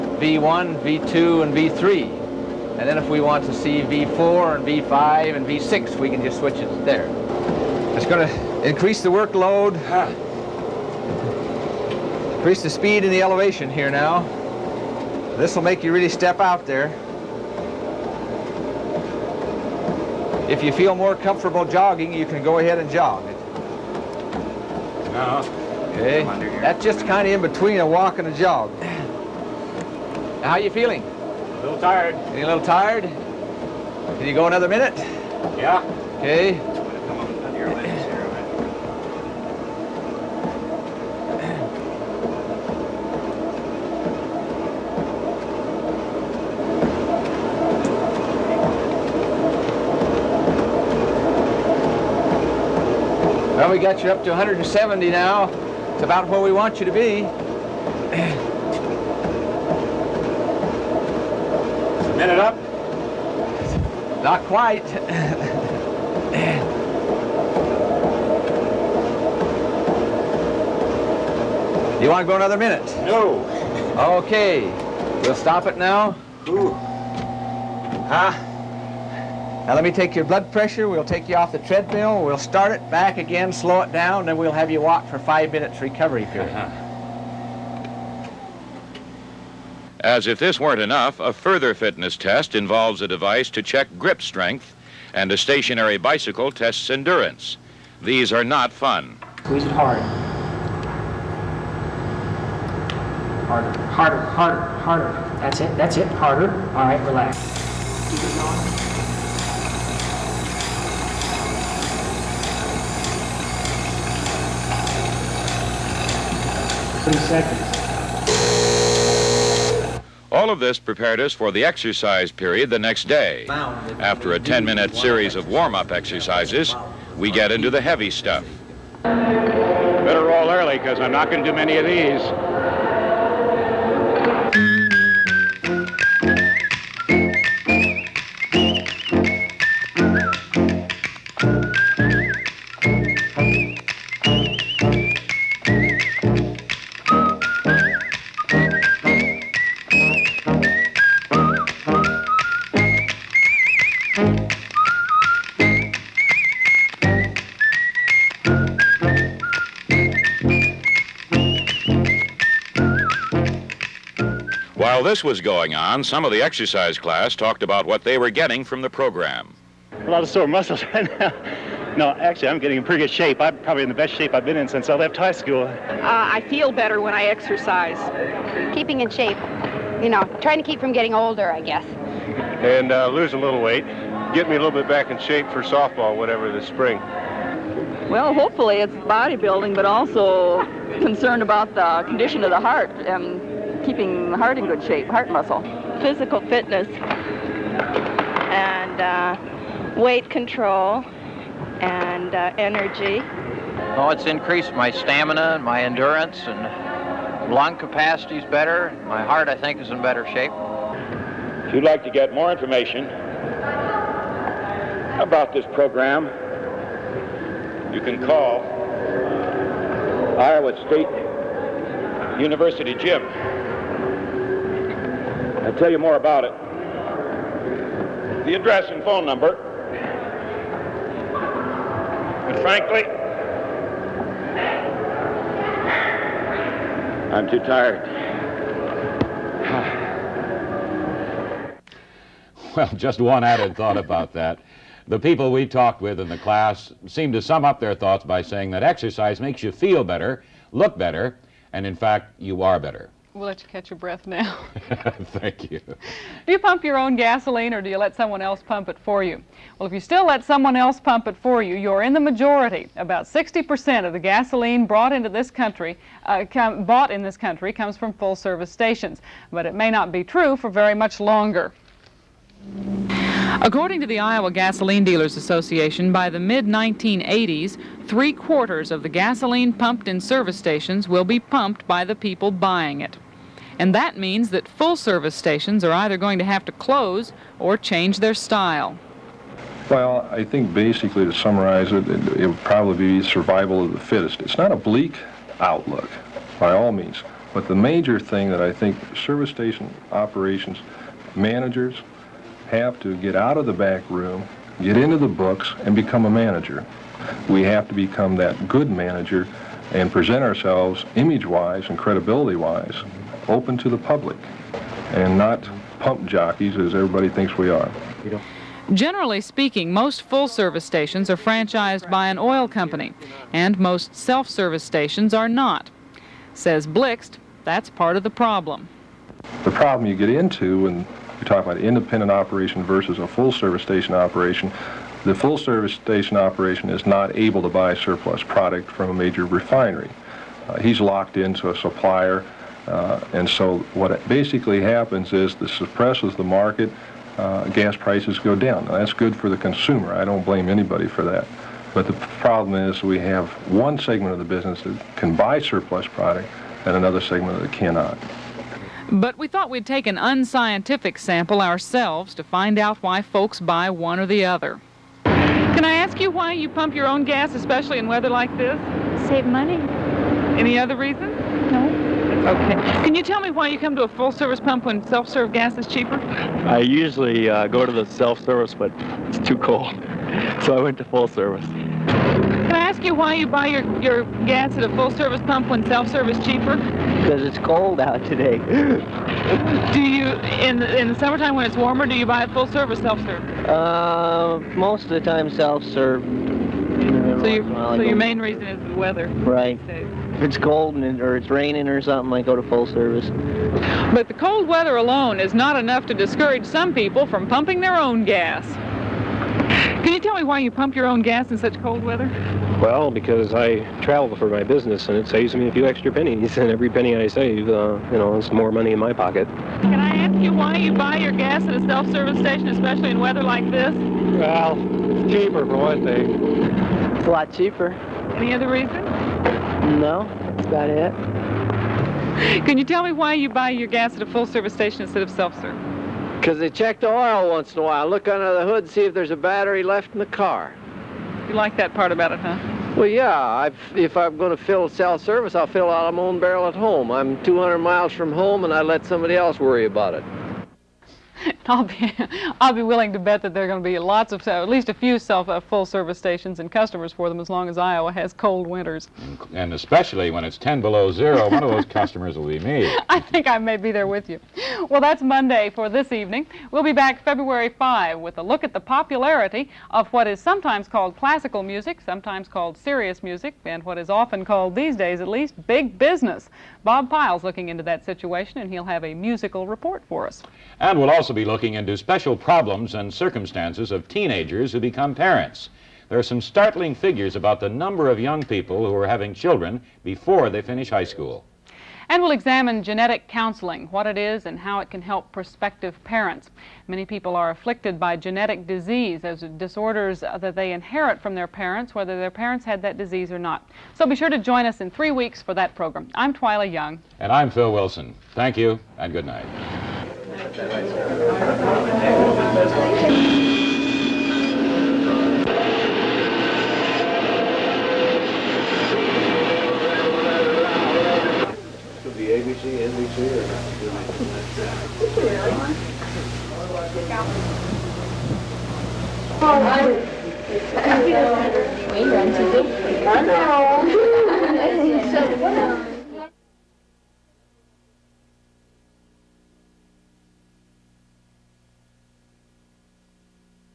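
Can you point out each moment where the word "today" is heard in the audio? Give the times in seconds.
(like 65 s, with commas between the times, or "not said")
388 s.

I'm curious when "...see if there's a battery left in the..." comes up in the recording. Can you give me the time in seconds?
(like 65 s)
438 s.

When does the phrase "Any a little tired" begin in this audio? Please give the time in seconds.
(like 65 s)
32 s.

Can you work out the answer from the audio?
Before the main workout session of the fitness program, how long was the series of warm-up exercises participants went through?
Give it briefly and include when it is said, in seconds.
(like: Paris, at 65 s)
10 minutes, at 124 s.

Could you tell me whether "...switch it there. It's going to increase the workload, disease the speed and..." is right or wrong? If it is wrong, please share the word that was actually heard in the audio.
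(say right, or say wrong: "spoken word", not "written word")
wrong: "increase", not "disease".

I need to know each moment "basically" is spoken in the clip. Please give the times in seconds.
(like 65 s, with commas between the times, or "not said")
290 s, 344 s.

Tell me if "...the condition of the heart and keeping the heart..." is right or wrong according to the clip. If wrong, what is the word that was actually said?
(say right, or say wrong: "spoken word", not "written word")
right.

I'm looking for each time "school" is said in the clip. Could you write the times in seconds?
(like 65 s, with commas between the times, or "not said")
175 s, 491 s.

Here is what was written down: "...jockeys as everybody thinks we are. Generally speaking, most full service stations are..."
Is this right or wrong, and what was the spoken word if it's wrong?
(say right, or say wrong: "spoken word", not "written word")
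right.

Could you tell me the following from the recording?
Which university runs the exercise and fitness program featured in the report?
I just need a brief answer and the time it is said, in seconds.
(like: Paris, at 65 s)
Iowa State University, at 220 s.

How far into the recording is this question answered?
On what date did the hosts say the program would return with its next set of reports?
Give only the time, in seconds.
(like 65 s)
467 s.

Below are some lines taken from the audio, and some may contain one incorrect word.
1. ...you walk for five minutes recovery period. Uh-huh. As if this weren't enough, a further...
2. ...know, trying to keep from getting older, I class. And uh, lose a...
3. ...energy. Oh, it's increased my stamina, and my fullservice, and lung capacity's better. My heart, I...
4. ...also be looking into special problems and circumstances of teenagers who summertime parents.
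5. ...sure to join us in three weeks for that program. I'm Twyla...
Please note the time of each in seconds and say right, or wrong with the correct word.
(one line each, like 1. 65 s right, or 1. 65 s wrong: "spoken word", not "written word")
1. 84 s right
2. 180 s wrong: "guess", not "class"
3. 202 s wrong: "endurance", not "fullservice"
4. 481 s wrong: "become", not "summertime"
5. 504 s right.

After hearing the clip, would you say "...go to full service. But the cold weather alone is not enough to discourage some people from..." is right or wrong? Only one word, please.
right.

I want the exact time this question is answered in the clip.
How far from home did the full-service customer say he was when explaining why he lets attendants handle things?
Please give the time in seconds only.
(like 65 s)
447 s.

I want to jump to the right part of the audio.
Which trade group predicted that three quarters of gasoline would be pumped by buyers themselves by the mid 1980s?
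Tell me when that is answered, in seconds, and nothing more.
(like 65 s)
274 s.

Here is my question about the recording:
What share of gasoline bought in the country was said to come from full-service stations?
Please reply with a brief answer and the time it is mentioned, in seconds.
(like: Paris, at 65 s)
60%, at 263 s.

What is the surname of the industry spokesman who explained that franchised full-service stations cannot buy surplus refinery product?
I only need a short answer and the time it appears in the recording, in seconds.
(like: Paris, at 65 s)
Blixt, at 326 s.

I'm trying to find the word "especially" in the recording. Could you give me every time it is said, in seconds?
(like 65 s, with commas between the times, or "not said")
367 s, 422 s, 459 s.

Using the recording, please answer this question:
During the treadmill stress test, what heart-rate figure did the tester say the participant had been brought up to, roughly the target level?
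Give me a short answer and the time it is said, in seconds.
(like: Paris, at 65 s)
170, at 54 s.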